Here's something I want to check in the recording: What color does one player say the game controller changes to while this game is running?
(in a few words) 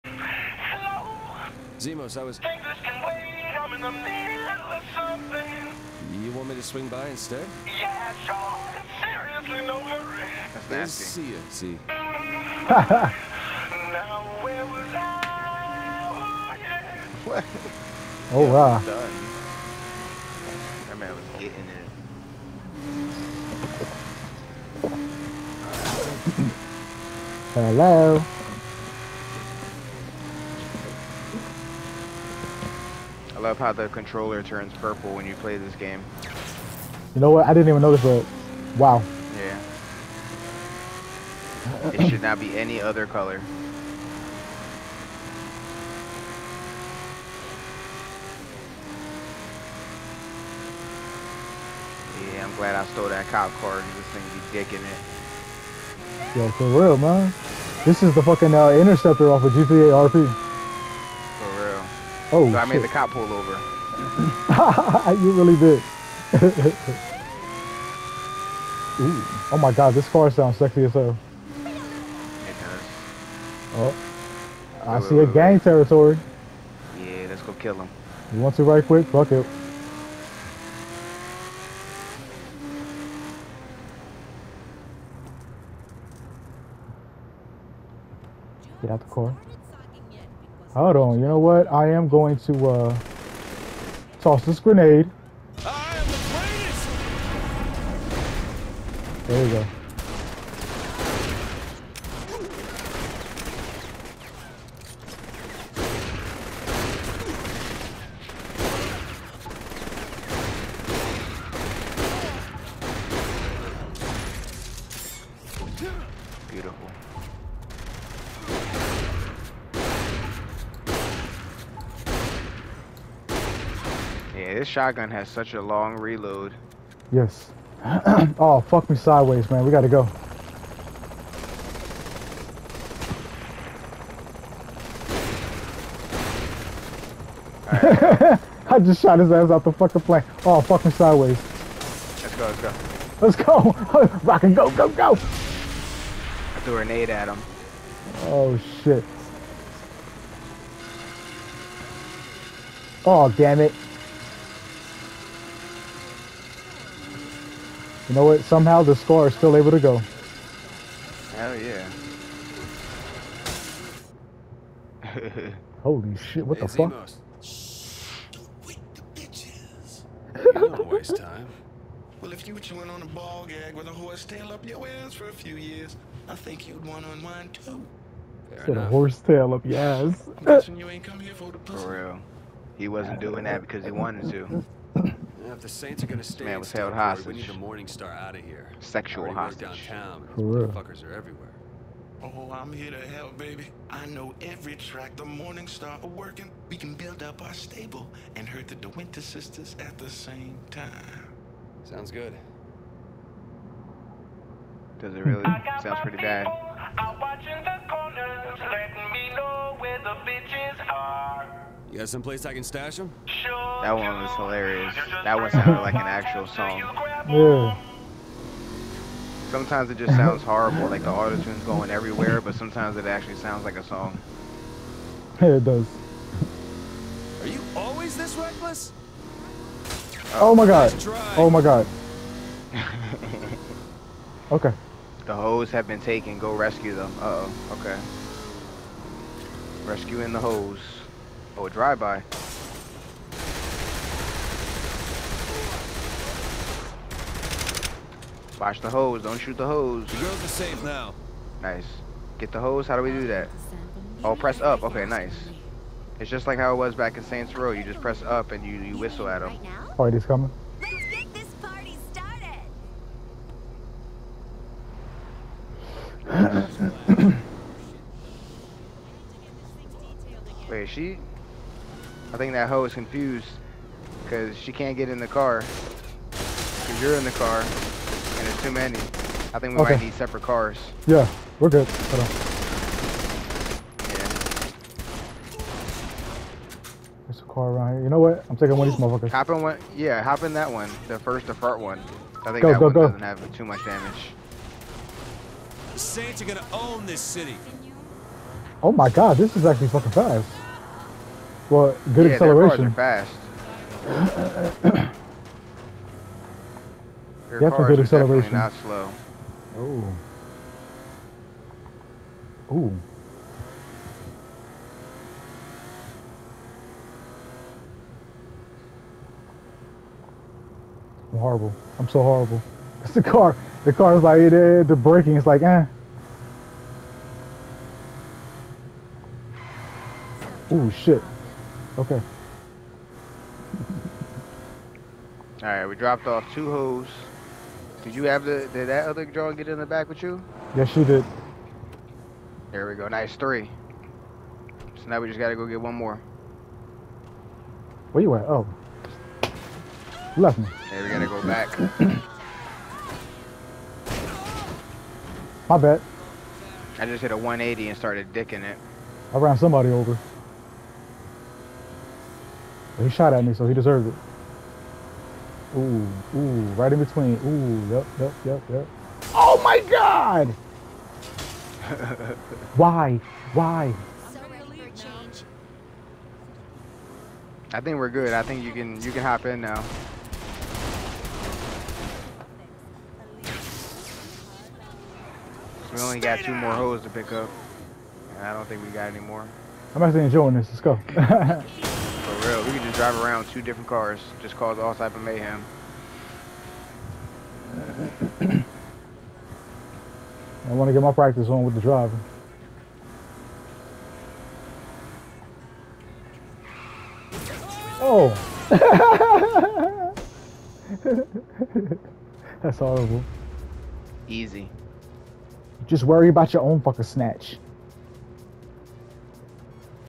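purple.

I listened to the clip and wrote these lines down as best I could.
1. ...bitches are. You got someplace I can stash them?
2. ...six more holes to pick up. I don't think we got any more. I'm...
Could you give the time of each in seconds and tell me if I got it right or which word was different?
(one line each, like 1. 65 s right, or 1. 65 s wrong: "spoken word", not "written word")
1. 210 s right
2. 386 s wrong: "two", not "six".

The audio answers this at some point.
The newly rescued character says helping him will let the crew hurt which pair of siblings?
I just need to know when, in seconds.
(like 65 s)
198 s.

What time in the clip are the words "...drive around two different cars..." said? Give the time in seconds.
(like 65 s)
392 s.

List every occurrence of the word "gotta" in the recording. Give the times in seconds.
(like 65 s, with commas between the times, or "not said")
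129 s, 345 s, 351 s.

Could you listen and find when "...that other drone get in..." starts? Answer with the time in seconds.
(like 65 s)
338 s.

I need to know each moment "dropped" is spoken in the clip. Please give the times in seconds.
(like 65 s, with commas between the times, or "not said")
335 s.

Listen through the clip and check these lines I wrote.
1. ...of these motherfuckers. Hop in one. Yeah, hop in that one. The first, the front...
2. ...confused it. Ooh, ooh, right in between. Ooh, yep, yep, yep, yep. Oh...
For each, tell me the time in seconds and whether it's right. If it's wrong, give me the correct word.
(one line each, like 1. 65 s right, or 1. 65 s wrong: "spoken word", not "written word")
1. 288 s right
2. 363 s wrong: "deserved", not "confused".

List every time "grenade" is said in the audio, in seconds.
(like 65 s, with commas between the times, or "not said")
94 s, 146 s.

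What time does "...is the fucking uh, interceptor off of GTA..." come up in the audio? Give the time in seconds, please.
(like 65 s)
58 s.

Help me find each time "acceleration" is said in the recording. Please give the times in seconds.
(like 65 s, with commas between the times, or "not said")
302 s, 308 s.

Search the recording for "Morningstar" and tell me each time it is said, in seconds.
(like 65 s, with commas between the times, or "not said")
187 s, 195 s.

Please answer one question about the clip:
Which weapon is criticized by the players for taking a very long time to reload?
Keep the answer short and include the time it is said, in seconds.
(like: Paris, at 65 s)
shotgun, at 124 s.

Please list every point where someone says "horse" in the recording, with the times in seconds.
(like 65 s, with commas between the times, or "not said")
173 s, 178 s.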